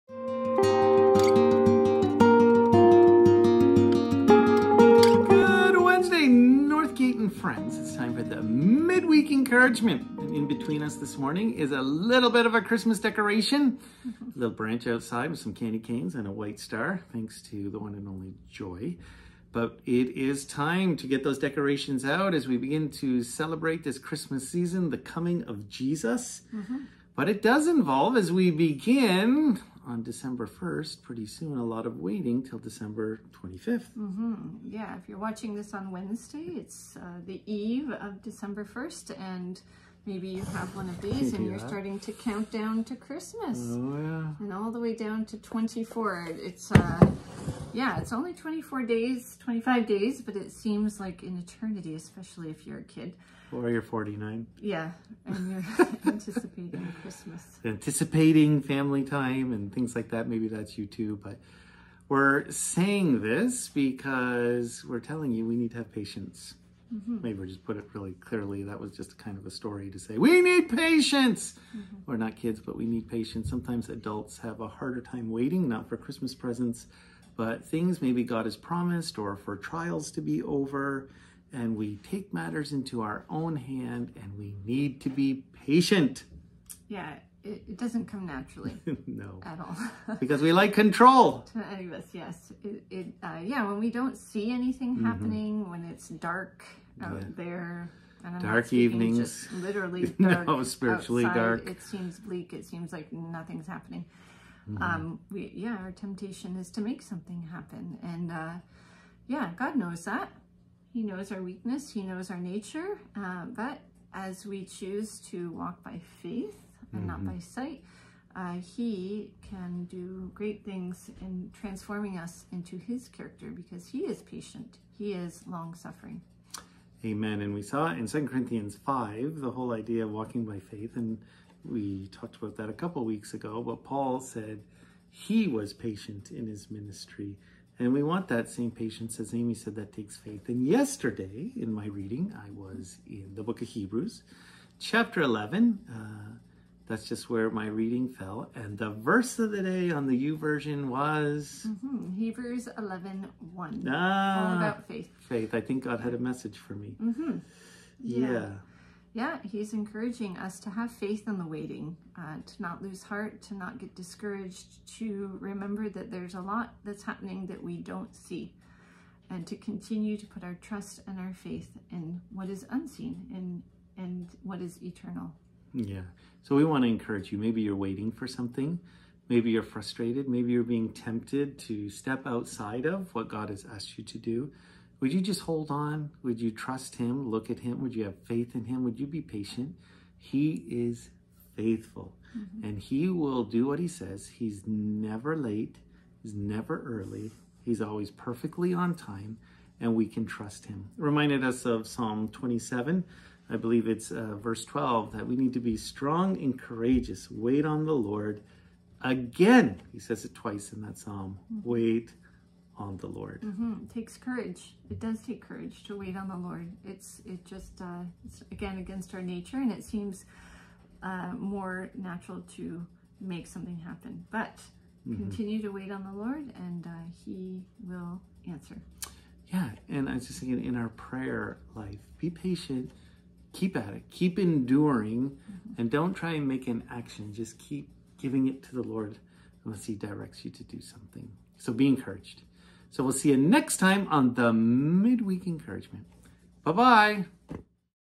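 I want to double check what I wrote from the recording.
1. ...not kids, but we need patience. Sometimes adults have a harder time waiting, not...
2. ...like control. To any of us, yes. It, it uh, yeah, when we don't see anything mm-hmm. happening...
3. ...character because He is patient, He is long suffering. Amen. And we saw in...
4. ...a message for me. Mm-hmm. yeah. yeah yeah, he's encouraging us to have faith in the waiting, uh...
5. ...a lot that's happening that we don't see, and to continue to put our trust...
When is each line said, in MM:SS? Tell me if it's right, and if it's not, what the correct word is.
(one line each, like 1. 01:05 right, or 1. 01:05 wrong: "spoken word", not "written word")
1. 01:12 right
2. 01:30 right
3. 02:03 right
4. 02:36 right
5. 02:46 right.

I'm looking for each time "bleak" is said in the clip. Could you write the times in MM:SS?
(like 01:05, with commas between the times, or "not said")
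01:42.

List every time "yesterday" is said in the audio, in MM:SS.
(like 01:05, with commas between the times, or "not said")
02:20.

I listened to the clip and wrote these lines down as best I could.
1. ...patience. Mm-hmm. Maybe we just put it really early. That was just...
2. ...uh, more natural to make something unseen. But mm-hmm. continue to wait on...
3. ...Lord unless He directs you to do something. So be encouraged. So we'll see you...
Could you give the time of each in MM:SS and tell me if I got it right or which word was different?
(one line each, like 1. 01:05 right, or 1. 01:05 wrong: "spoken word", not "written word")
1. 01:05 wrong: "clearly", not "early"
2. 03:41 wrong: "happen", not "unseen"
3. 03:58 right.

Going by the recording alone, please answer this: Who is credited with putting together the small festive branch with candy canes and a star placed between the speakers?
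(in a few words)
Joy.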